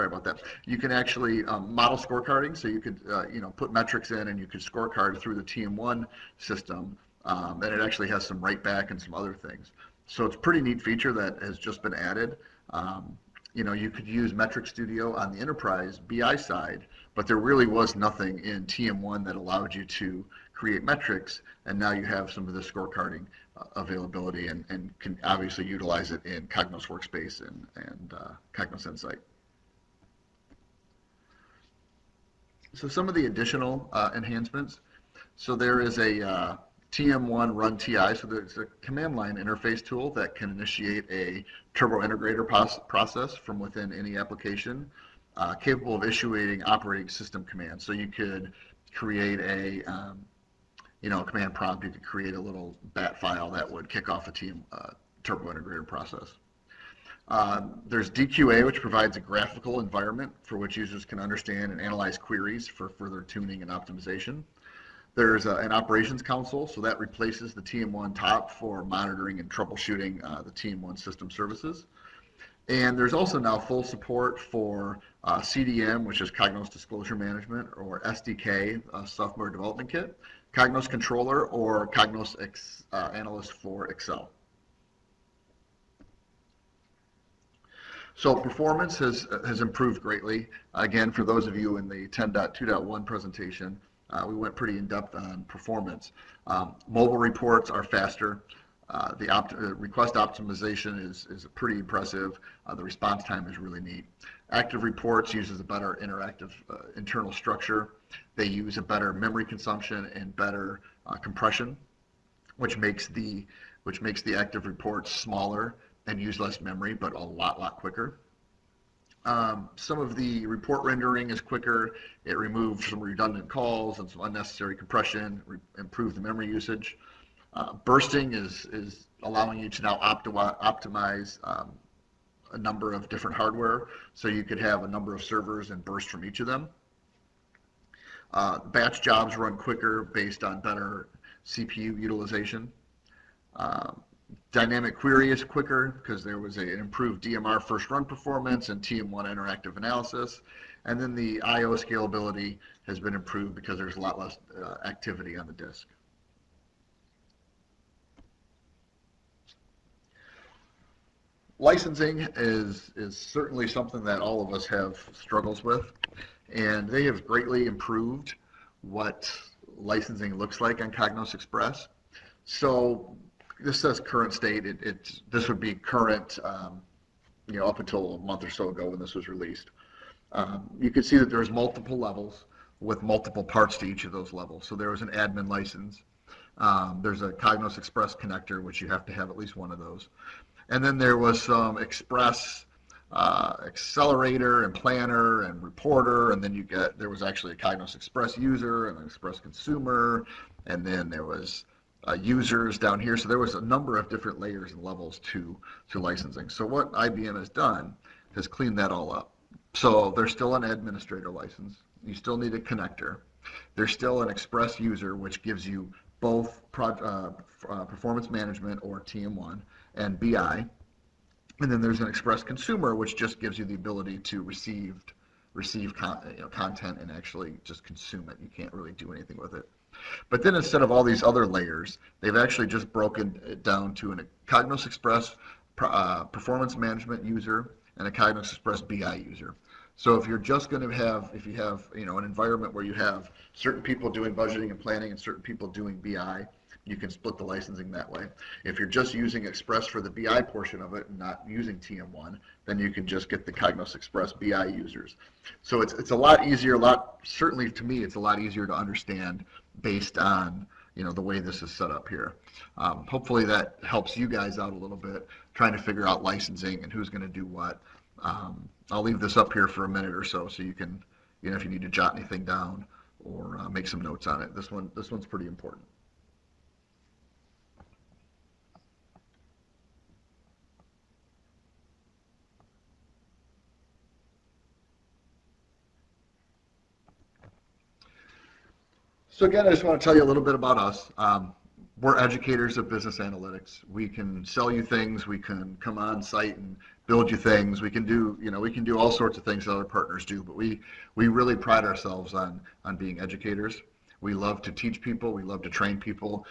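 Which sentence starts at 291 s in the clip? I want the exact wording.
Um, we're educators of business analytics.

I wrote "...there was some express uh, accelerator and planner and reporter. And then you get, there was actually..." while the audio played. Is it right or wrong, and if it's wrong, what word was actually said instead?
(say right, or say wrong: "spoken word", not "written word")
right.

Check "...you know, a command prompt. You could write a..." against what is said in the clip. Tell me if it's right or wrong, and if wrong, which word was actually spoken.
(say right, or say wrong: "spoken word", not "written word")
wrong: "create", not "write".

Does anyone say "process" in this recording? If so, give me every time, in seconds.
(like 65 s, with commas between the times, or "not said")
42 s, 55 s.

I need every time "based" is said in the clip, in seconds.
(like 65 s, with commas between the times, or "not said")
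140 s, 259 s.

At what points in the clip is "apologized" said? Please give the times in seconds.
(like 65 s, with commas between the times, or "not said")
not said.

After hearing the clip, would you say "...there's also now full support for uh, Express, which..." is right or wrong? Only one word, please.
wrong.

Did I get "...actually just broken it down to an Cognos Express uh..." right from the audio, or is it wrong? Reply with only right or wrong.
right.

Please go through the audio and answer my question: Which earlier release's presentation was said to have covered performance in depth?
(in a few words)
10.2.1.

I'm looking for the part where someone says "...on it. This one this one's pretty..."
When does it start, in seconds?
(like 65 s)
274 s.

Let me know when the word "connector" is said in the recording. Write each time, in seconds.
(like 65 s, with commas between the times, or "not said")
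188 s, 212 s.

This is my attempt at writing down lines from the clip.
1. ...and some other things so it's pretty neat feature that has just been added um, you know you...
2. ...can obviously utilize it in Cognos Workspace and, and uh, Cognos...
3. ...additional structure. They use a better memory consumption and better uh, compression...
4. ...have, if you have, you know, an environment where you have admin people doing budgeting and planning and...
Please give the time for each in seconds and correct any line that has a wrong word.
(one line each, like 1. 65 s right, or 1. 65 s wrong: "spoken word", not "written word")
1. 8 s right
2. 24 s right
3. 106 s wrong: "internal", not "additional"
4. 240 s wrong: "certain", not "admin".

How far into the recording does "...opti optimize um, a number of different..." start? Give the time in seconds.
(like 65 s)
129 s.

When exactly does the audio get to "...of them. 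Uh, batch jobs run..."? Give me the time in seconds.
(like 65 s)
136 s.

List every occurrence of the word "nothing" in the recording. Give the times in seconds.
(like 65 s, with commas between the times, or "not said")
17 s.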